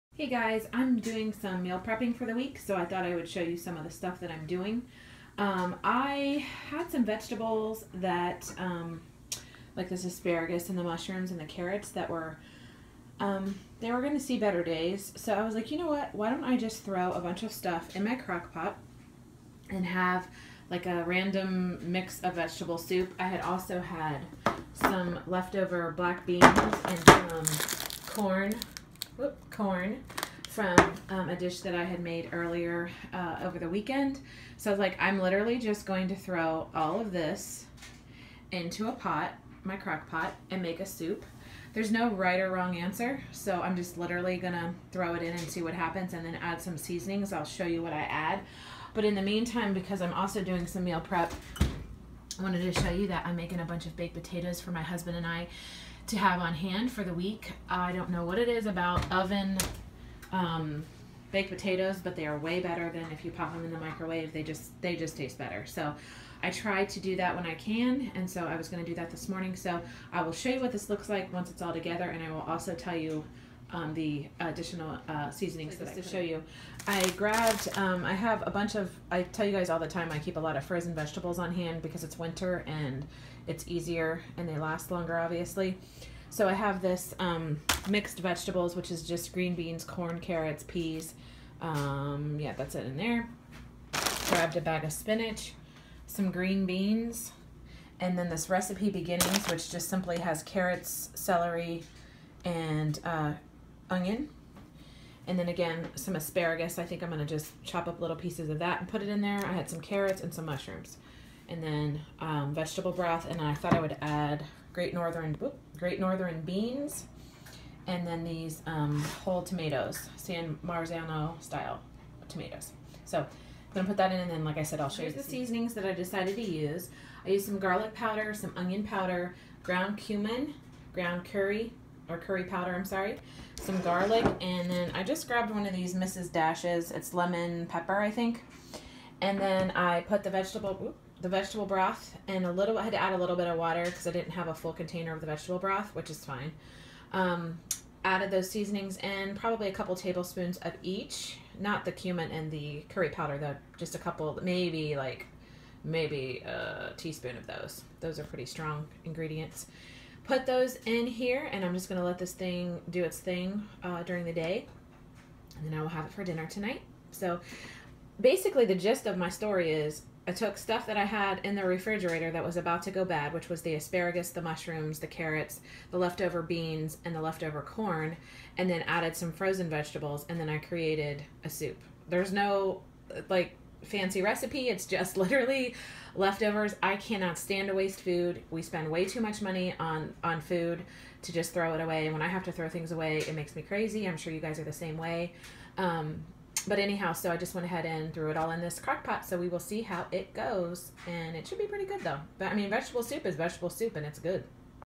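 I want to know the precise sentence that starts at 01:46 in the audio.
I think I'm gonna just chop up little pieces of that and put it in there.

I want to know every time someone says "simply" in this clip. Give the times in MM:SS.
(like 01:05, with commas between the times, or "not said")
01:39.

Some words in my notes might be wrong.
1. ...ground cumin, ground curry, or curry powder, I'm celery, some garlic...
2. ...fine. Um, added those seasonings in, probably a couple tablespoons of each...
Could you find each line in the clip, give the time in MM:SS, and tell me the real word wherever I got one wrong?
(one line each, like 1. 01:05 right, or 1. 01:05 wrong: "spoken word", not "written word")
1. 02:09 wrong: "sorry", not "celery"
2. 02:26 right.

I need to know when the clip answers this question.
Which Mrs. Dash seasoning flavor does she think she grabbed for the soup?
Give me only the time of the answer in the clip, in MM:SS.
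02:17.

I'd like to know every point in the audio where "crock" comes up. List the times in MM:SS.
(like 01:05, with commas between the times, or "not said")
00:18, 00:39, 03:18.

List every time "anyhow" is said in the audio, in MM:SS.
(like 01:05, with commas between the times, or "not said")
03:16.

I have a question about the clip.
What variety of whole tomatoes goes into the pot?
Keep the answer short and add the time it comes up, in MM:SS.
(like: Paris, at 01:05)
San Marzano, at 02:00.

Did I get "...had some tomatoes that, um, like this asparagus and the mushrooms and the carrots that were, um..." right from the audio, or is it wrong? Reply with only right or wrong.
wrong.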